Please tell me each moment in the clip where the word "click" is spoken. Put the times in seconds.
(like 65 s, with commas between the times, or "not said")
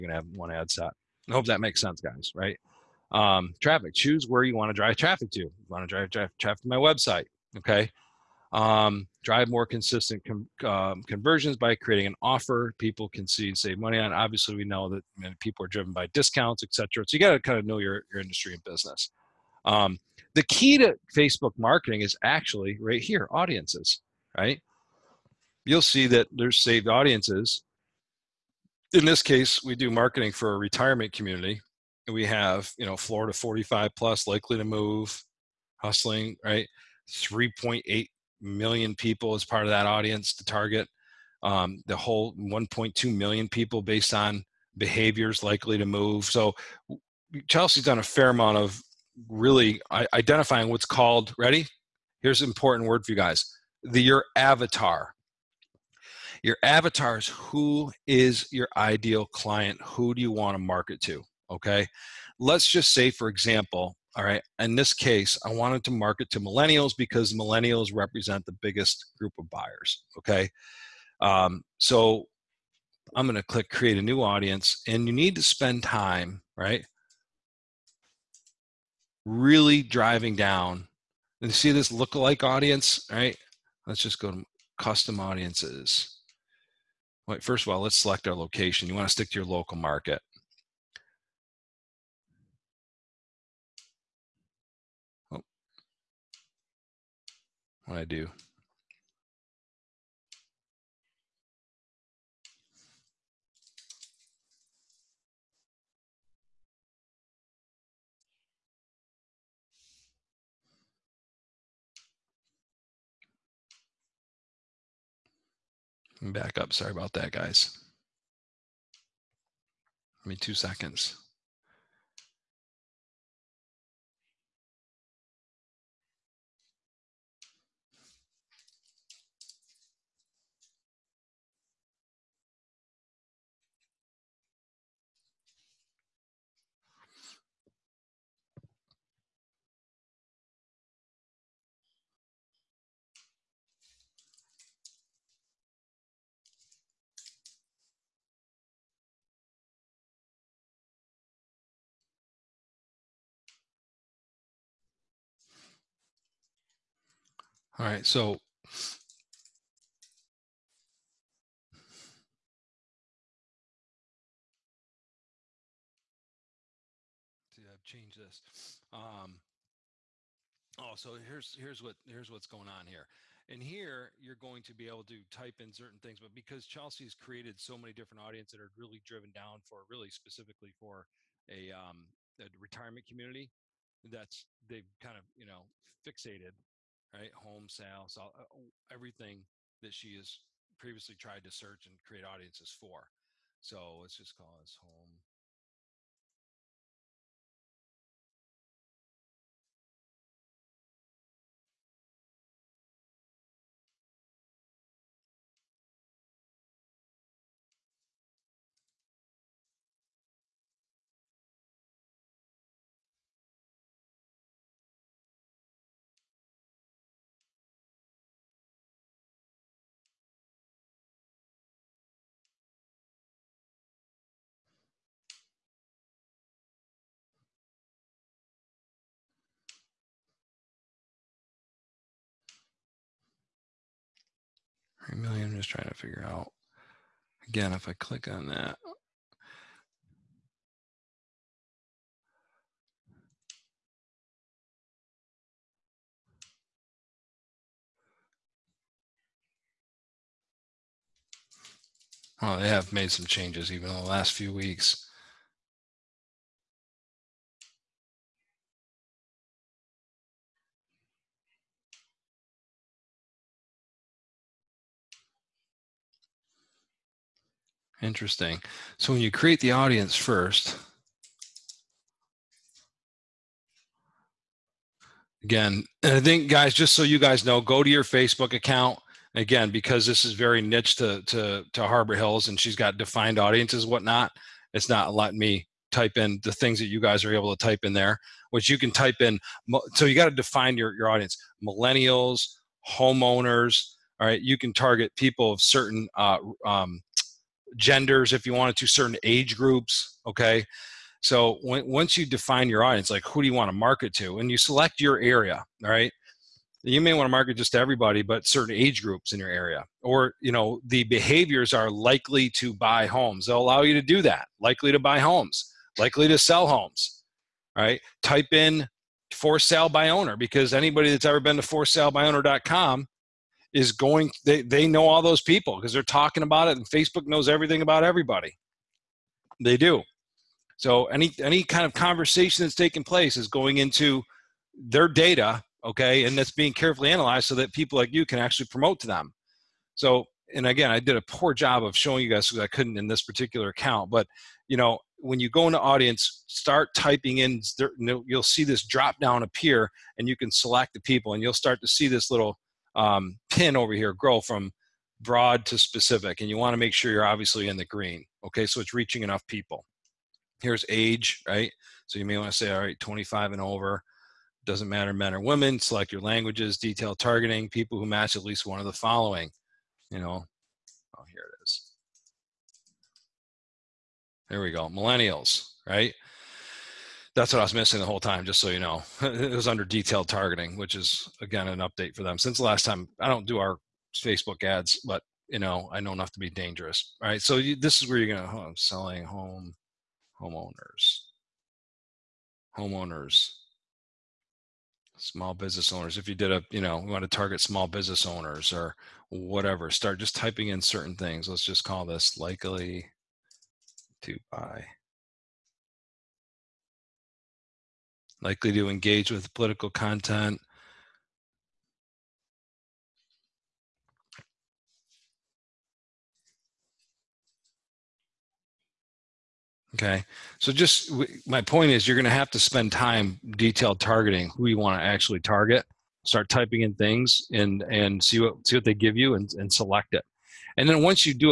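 73 s, 237 s.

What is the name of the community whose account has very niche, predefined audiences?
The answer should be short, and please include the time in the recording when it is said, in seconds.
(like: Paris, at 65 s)
Harbor Hills, at 281 s.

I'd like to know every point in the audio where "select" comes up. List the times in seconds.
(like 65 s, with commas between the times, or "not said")
87 s, 304 s, 350 s, 365 s, 429 s.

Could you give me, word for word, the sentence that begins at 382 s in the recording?
Since the last time, I don't do our Facebook ads, but you know, I know enough to be dangerous.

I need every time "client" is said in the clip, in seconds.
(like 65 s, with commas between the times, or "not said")
59 s.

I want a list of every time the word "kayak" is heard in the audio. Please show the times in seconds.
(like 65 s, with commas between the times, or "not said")
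not said.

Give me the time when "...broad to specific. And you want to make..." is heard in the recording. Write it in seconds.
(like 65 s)
355 s.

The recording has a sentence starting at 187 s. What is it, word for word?
Home sales, all, uh, everything that she has previously tried to search and create audiences for.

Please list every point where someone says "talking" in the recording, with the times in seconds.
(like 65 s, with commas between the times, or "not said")
326 s.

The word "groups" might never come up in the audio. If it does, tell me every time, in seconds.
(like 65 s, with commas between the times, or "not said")
69 s, 299 s, 309 s.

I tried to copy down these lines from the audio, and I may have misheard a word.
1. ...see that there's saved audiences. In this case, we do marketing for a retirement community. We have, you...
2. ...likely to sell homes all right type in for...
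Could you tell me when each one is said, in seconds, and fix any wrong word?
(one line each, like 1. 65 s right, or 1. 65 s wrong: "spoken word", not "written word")
1. 25 s right
2. 315 s right.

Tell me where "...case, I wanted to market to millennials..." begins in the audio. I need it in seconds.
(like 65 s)
64 s.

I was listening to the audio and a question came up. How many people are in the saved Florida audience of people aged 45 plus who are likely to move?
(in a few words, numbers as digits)
3.8 million.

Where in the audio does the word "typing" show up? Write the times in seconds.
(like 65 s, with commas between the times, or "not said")
346 s, 400 s, 426 s.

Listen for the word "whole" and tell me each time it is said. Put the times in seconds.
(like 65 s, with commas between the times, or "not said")
41 s, 378 s.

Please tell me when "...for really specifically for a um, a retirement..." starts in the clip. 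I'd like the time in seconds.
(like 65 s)
179 s.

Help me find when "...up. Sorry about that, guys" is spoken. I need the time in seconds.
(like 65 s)
116 s.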